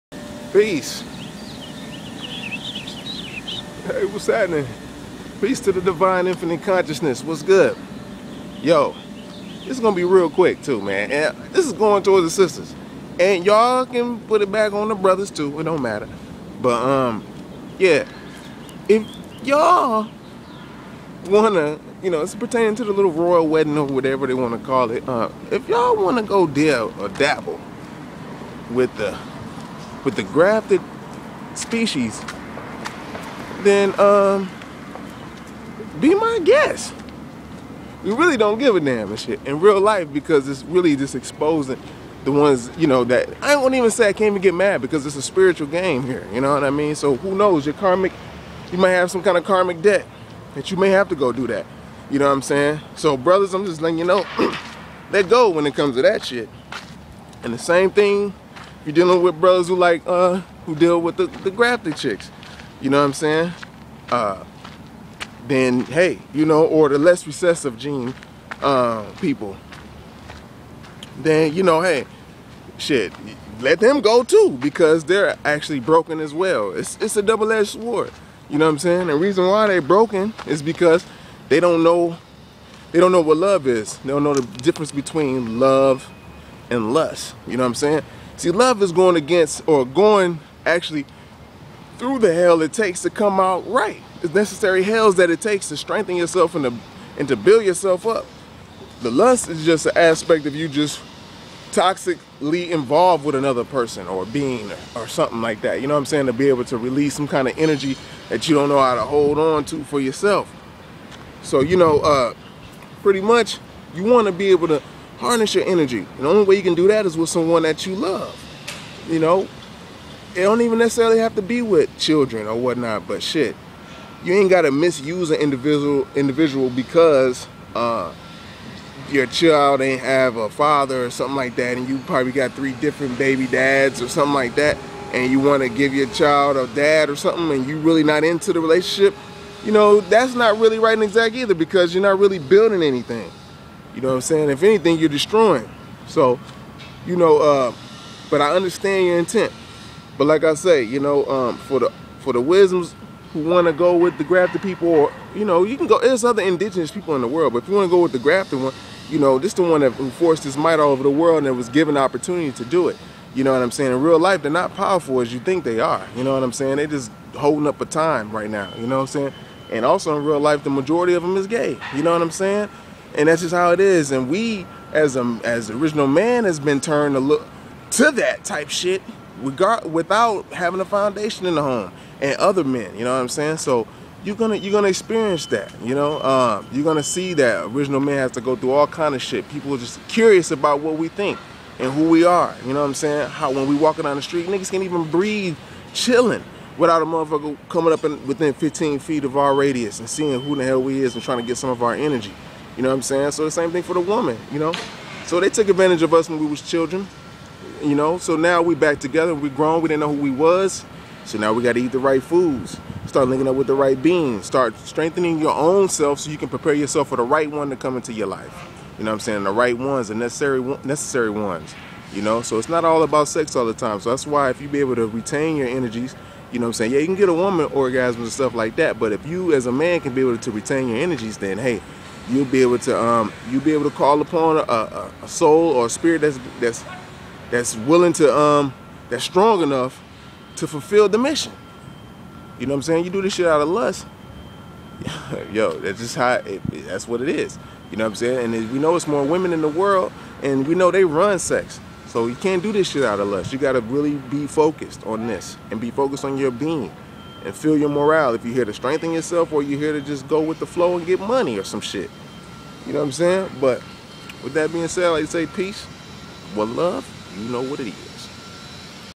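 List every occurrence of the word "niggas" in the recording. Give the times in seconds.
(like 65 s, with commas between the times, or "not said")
194 s.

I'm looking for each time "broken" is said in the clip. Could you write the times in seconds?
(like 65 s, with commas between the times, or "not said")
75 s, 79 s.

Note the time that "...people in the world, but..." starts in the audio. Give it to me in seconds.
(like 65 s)
156 s.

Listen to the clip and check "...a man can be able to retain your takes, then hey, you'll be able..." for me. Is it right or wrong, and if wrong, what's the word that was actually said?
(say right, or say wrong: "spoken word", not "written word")
wrong: "energies", not "takes".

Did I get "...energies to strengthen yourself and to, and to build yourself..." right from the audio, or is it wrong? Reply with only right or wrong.
wrong.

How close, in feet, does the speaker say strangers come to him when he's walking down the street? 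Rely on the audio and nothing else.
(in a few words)
15 feet.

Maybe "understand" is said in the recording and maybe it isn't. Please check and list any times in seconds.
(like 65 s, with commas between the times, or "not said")
148 s.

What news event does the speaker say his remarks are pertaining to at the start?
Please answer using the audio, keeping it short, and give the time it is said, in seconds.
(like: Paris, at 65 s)
royal wedding, at 23 s.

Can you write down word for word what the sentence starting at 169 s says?
And also in real life, the majority of them is gay.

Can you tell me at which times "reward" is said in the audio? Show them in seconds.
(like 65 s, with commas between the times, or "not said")
not said.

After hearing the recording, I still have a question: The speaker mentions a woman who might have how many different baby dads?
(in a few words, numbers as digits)
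3.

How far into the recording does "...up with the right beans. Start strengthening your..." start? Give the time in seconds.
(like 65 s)
213 s.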